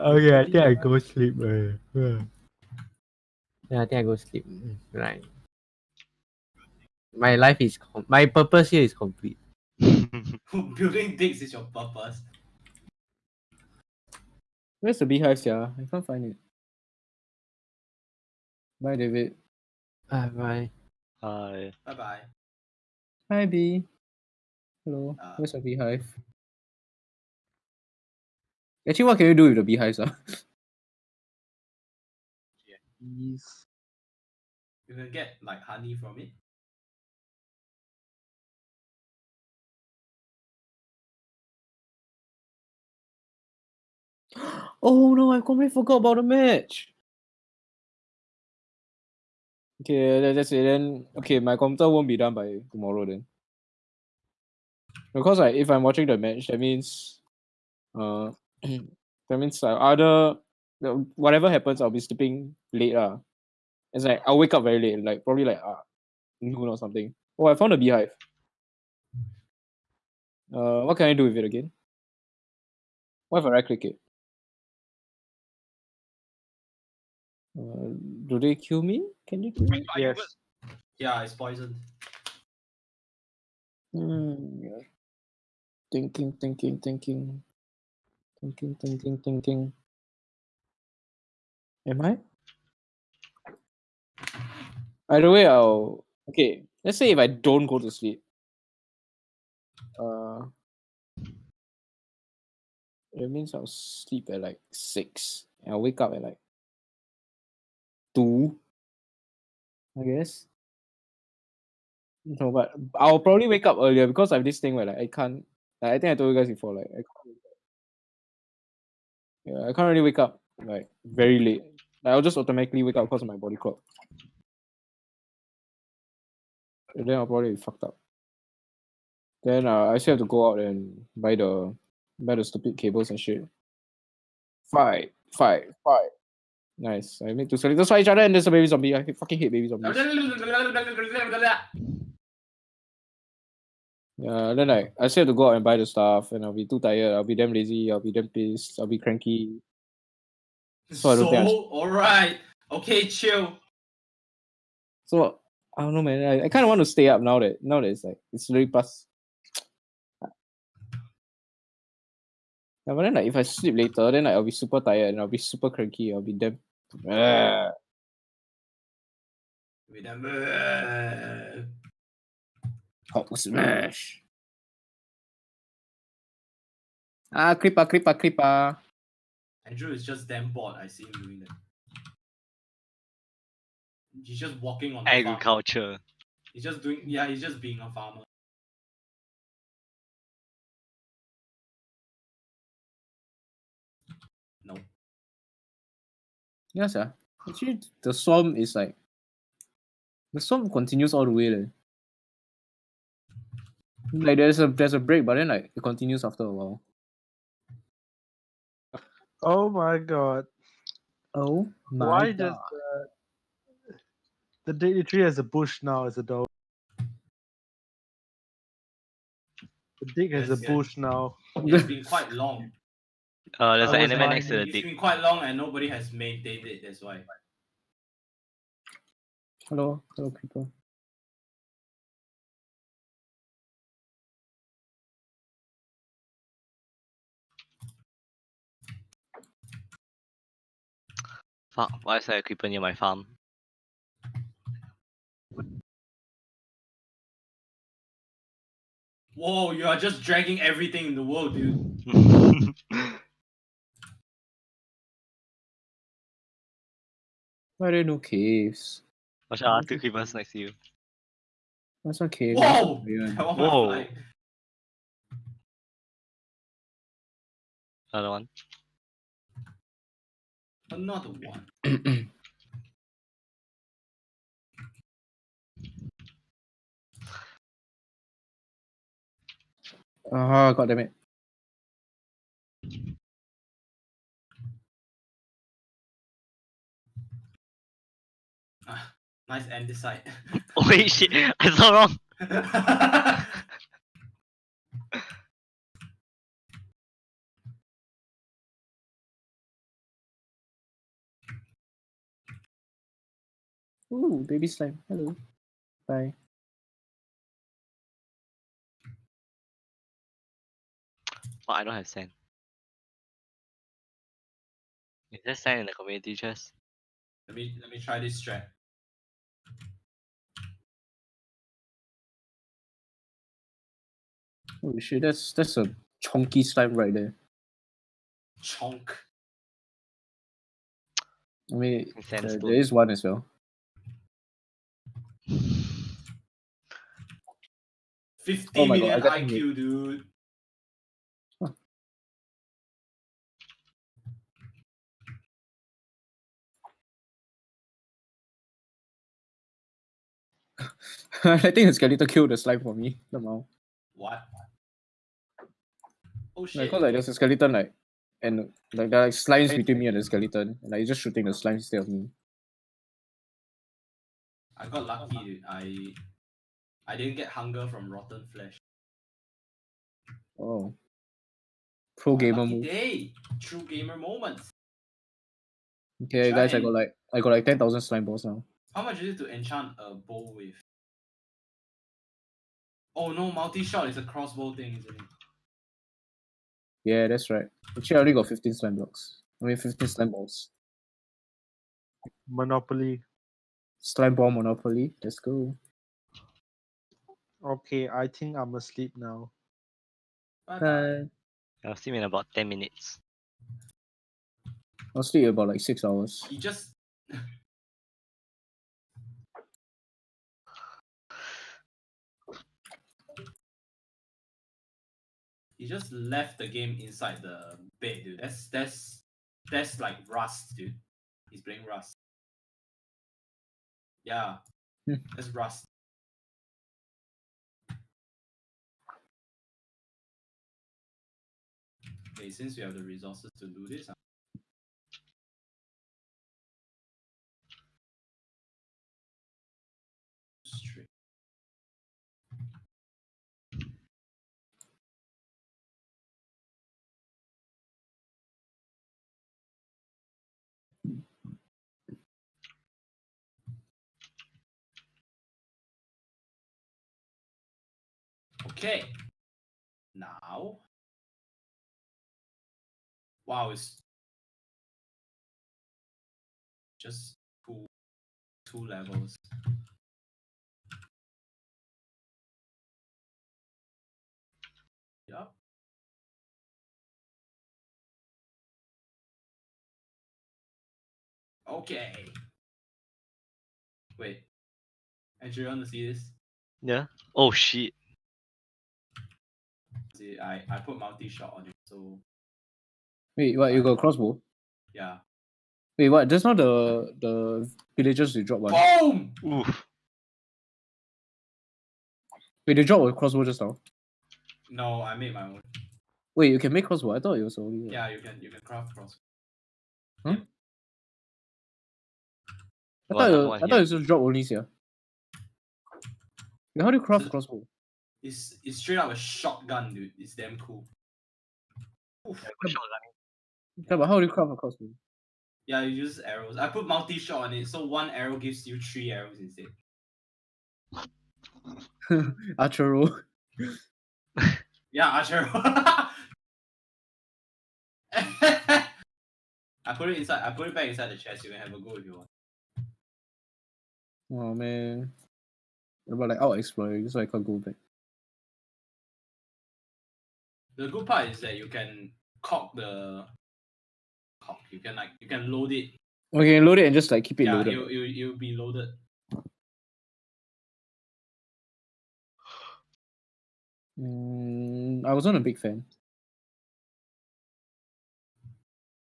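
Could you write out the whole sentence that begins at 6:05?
I I didn't get hunger from rotten flesh.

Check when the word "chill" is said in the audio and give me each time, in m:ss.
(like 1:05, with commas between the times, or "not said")
2:33.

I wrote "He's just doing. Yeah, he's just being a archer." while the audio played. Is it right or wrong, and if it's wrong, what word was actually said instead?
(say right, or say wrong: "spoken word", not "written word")
wrong: "farmer", not "archer".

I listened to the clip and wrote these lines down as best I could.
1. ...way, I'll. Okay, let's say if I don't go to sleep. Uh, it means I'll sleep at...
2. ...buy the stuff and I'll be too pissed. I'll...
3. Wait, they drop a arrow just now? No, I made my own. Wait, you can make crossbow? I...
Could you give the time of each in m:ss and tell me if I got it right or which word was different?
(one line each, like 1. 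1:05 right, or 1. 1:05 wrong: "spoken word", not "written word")
1. 1:35 right
2. 2:25 wrong: "tired", not "pissed"
3. 8:22 wrong: "crossbow", not "arrow".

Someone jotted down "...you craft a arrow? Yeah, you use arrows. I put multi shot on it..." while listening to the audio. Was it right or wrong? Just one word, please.
wrong.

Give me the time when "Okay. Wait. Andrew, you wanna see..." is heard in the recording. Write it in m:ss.
8:01.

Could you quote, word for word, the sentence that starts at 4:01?
Fuck, why is there a creeper near my farm?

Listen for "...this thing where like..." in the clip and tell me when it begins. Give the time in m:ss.
1:54.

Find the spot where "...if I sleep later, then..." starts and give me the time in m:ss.
2:43.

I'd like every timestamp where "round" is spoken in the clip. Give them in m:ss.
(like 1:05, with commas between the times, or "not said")
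not said.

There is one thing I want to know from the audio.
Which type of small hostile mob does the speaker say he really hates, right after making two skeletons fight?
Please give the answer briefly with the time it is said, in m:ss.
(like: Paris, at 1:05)
Baby zombies, at 2:19.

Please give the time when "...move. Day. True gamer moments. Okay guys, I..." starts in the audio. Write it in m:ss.
6:12.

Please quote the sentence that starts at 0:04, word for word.
Right my life is com- my purpose here is complete.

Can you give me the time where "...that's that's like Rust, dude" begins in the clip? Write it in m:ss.
6:58.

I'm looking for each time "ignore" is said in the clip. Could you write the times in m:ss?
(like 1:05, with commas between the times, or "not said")
not said.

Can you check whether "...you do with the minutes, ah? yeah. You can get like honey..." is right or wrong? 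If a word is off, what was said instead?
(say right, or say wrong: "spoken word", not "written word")
wrong: "beehives", not "minutes".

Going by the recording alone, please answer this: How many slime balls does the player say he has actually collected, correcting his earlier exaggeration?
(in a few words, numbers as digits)
15.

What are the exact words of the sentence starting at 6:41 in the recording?
I'll sleep in about 10 minutes.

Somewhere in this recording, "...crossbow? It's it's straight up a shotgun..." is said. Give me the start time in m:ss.
8:37.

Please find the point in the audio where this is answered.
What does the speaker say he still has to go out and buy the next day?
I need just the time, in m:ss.
2:12.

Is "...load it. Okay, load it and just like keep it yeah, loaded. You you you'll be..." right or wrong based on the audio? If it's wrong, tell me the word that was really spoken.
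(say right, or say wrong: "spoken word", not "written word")
right.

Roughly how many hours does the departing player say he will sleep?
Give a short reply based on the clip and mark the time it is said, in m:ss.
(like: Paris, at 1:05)
6 hours, at 6:45.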